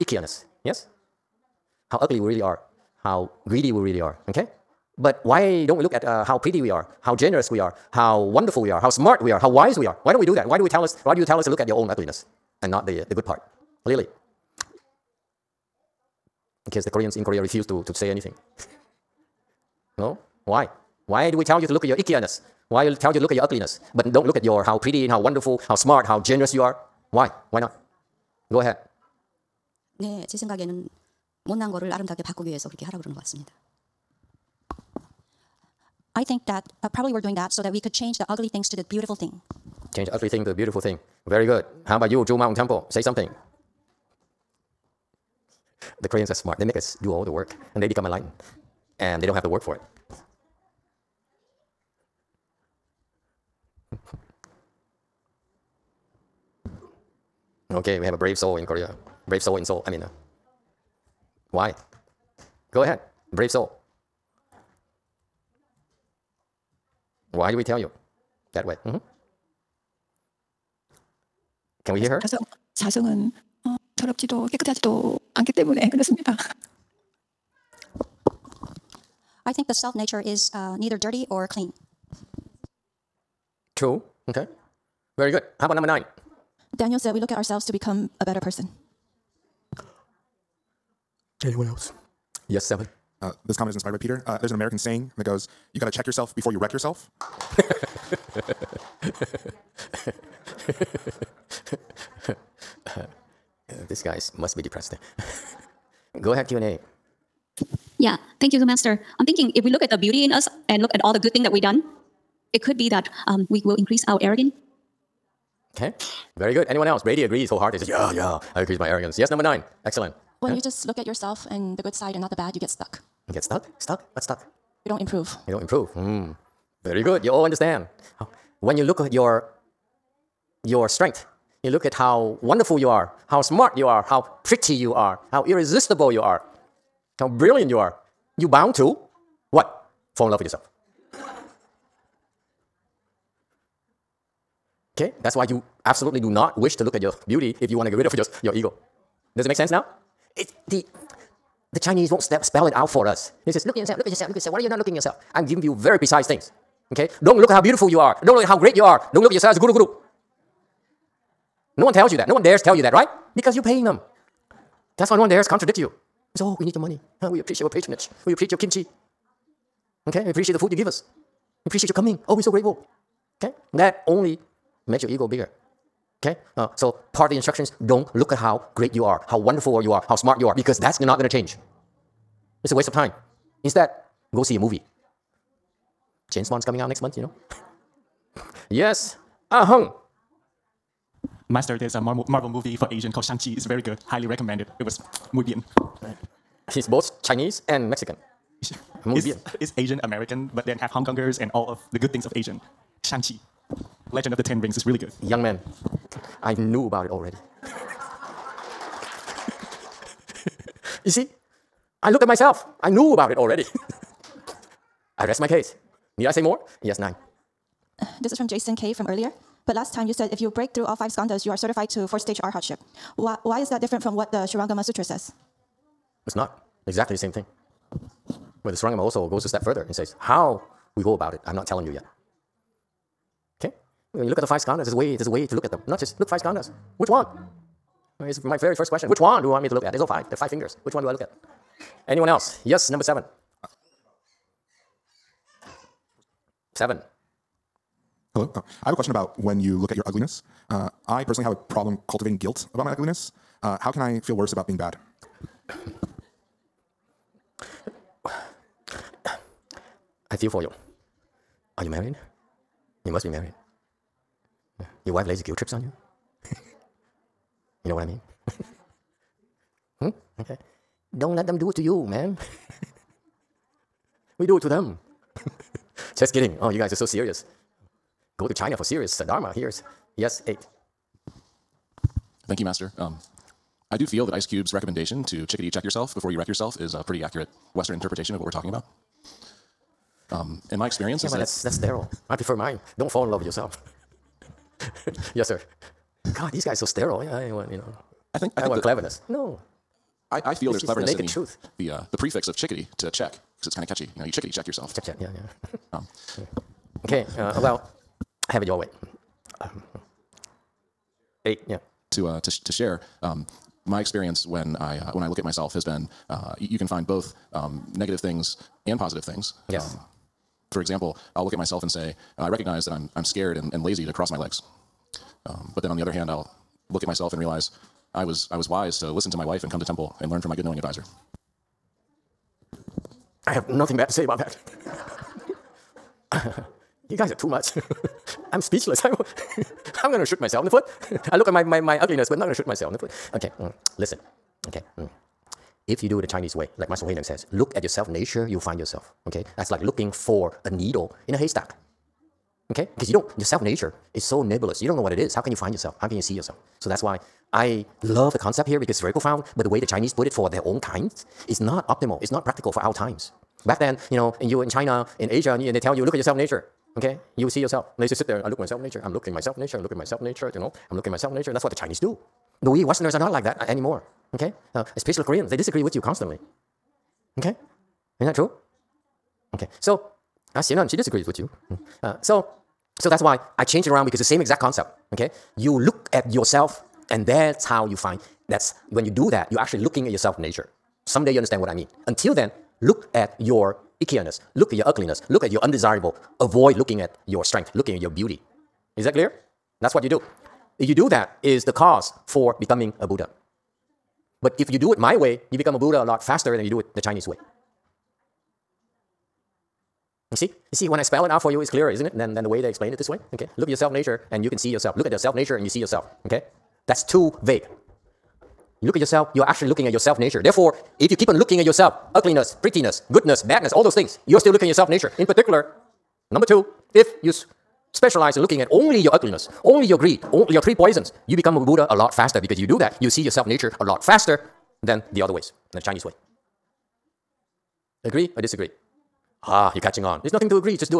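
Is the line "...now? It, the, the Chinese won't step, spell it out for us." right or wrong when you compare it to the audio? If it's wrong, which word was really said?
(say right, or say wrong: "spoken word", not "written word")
right.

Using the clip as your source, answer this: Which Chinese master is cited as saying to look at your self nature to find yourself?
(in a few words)
Master Hui Neng.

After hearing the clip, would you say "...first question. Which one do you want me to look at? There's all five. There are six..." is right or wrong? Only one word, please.
wrong.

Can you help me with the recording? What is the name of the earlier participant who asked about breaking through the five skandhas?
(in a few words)
Jason K.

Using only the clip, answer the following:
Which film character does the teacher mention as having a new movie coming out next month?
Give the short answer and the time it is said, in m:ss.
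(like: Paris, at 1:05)
James Bond, at 3:06.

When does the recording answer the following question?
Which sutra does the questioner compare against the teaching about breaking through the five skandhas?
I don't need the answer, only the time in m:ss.
3:44.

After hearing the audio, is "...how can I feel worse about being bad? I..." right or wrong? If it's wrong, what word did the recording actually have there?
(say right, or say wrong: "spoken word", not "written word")
right.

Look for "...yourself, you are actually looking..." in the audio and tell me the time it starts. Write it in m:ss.
6:58.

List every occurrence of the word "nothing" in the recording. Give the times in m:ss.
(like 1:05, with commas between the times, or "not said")
5:33, 7:20.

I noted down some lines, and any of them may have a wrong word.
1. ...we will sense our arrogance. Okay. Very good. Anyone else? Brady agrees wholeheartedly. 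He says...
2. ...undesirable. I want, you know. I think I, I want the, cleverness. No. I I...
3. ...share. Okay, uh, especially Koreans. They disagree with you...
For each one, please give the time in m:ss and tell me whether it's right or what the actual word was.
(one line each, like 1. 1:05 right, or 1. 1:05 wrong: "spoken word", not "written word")
1. 1:53 wrong: "increase", not "sense"
2. 4:56 wrong: "sterile", not "undesirable"
3. 6:13 wrong: "anymore", not "share".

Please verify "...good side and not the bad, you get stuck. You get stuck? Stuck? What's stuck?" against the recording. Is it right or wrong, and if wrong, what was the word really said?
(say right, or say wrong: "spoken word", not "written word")
right.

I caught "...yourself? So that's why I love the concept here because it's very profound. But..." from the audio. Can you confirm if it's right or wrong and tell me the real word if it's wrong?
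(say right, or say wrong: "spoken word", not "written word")
right.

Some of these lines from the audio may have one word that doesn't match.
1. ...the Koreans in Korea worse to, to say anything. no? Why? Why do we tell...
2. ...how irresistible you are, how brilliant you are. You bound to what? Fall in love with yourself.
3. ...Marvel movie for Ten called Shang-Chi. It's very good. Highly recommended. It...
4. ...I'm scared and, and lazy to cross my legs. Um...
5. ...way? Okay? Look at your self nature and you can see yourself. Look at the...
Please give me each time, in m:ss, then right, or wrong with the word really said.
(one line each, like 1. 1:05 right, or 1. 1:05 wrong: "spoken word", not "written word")
1. 0:16 wrong: "refuse", not "worse"
2. 2:15 right
3. 3:12 wrong: "Asian", not "Ten"
4. 5:23 right
5. 6:53 right.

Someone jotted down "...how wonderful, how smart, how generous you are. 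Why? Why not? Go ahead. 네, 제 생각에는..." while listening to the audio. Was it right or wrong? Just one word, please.
right.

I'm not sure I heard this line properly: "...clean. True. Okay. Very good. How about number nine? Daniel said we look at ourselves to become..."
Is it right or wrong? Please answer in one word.
right.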